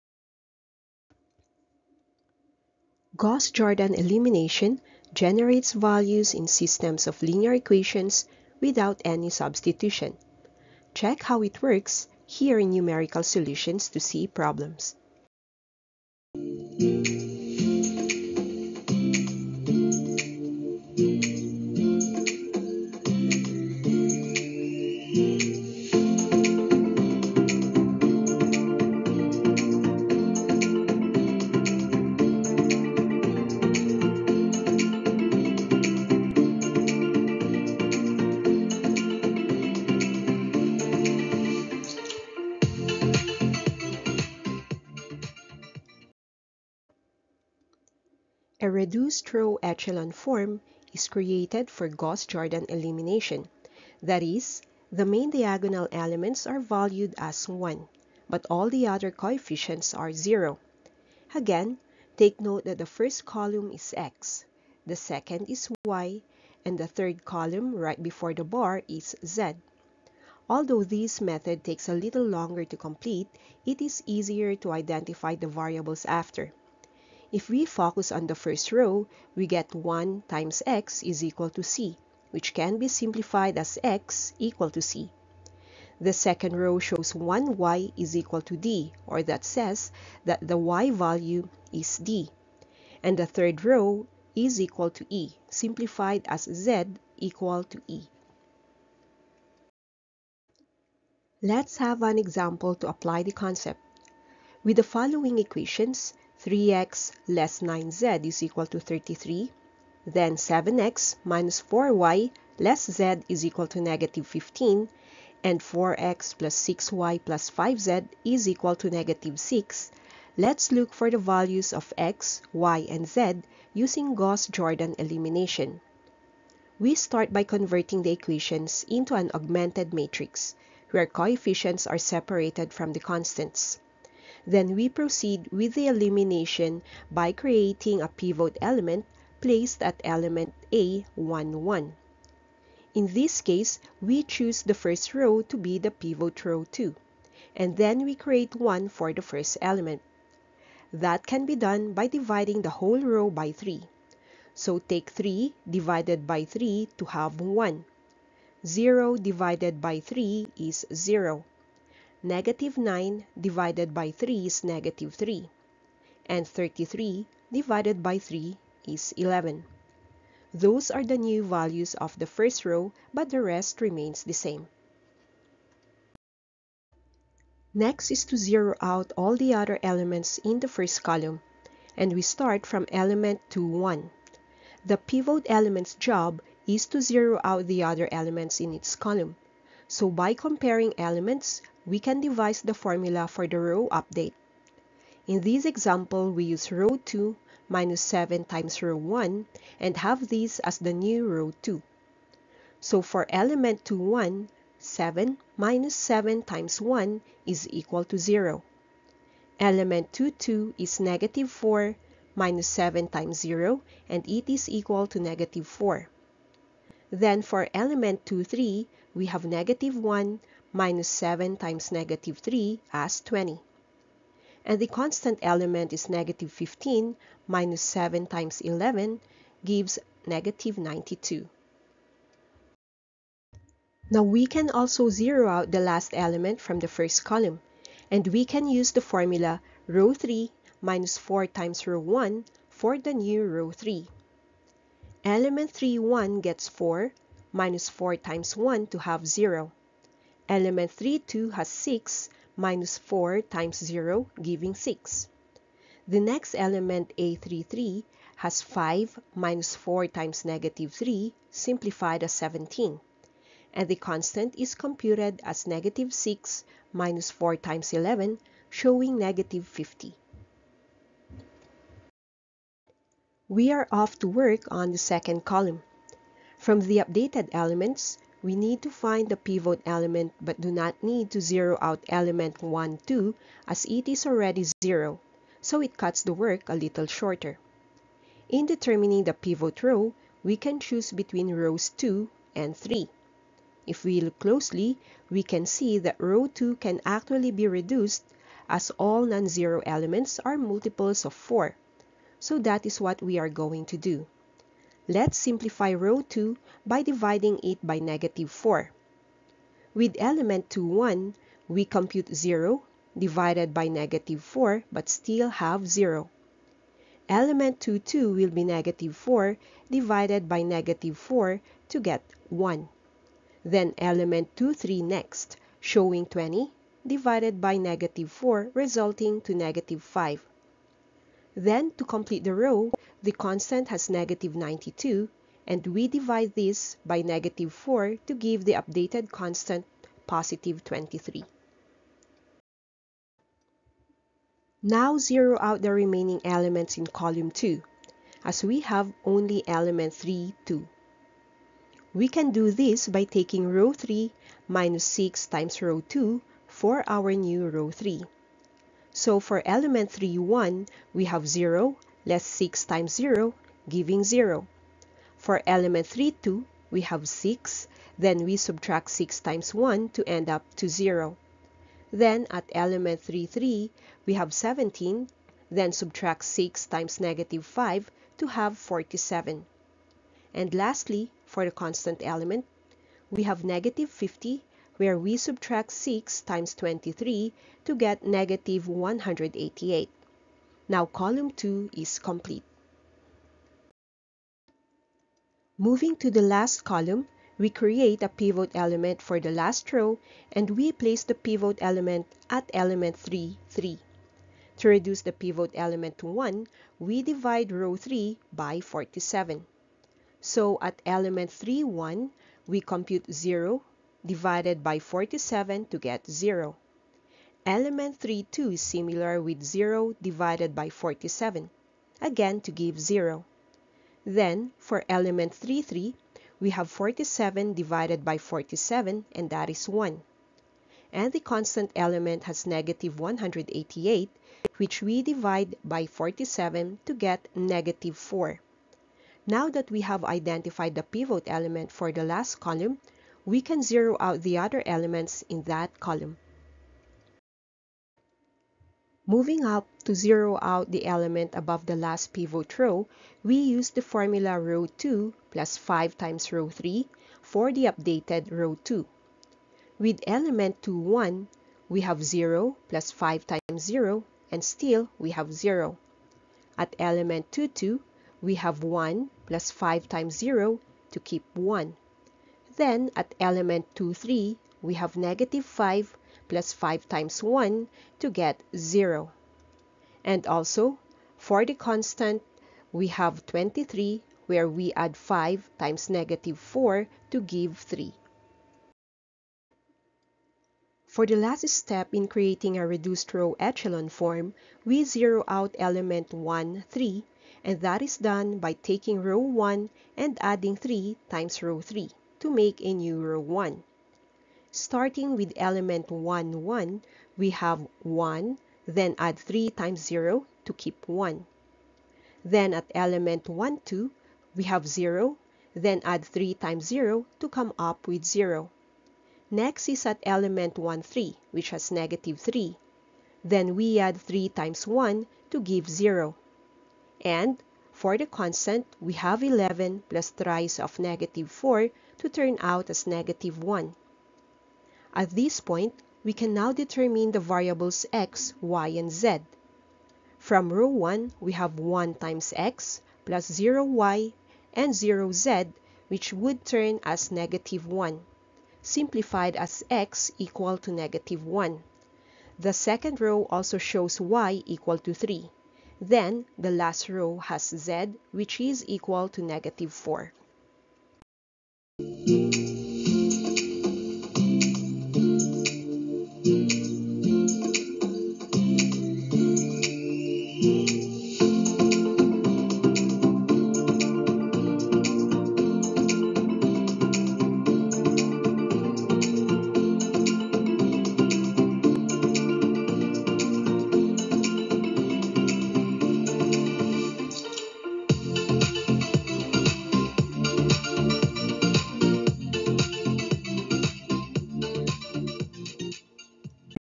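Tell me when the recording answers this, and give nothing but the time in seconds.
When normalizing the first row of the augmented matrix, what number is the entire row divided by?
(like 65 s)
152 s.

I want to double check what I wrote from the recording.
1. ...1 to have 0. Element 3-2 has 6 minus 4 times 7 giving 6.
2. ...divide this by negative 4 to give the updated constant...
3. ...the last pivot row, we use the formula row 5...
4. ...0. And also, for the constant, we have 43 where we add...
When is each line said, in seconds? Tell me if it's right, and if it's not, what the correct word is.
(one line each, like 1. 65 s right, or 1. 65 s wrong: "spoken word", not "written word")
1. 248 s wrong: "0", not "7"
2. 336 s right
3. 451 s wrong: "2", not "5"
4. 478 s wrong: "23", not "43".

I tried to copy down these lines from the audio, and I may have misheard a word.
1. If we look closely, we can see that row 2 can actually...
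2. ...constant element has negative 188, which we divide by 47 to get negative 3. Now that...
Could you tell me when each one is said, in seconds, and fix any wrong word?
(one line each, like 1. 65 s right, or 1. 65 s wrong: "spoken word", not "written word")
1. 293 s right
2. 431 s wrong: "4", not "3".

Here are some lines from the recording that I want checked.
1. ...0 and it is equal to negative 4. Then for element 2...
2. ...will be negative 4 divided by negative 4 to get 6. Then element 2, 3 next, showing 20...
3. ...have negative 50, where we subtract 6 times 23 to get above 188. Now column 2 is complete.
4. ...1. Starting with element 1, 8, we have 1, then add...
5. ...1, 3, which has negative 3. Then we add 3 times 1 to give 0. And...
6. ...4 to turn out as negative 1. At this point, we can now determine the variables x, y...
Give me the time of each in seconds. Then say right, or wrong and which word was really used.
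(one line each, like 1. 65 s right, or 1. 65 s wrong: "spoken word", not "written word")
1. 213 s right
2. 318 s wrong: "1", not "6"
3. 383 s wrong: "negative", not "above"
4. 503 s wrong: "1", not "8"
5. 520 s right
6. 531 s right.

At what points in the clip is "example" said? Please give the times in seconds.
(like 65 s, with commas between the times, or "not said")
102 s, 195 s.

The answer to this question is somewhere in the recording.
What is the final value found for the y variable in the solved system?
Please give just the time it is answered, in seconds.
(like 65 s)
554 s.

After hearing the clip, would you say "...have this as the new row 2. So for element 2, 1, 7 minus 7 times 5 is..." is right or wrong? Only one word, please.
wrong.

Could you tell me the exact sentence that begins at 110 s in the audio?
Then 7x minus 4y less z is equal to negative 15.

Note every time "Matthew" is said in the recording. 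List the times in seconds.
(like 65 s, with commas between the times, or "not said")
not said.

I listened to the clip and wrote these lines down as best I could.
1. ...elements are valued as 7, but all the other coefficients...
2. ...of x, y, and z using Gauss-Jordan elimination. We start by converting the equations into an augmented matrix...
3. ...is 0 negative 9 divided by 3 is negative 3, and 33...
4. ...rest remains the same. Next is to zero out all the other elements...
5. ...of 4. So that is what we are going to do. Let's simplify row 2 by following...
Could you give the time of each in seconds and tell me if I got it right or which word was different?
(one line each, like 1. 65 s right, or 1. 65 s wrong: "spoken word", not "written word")
1. 55 s wrong: "1", not "7"
2. 121 s right
3. 160 s right
4. 173 s right
5. 301 s wrong: "dividing", not "following".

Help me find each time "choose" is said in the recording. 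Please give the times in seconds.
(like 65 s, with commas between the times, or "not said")
144 s, 290 s.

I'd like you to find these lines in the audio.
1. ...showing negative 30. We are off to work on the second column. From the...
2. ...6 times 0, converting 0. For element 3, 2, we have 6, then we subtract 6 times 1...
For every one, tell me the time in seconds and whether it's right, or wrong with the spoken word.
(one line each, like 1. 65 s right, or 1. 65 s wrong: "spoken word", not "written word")
1. 268 s wrong: "50", not "30"
2. 362 s wrong: "giving", not "converting".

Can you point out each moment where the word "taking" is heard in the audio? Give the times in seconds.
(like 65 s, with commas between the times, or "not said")
353 s, 498 s.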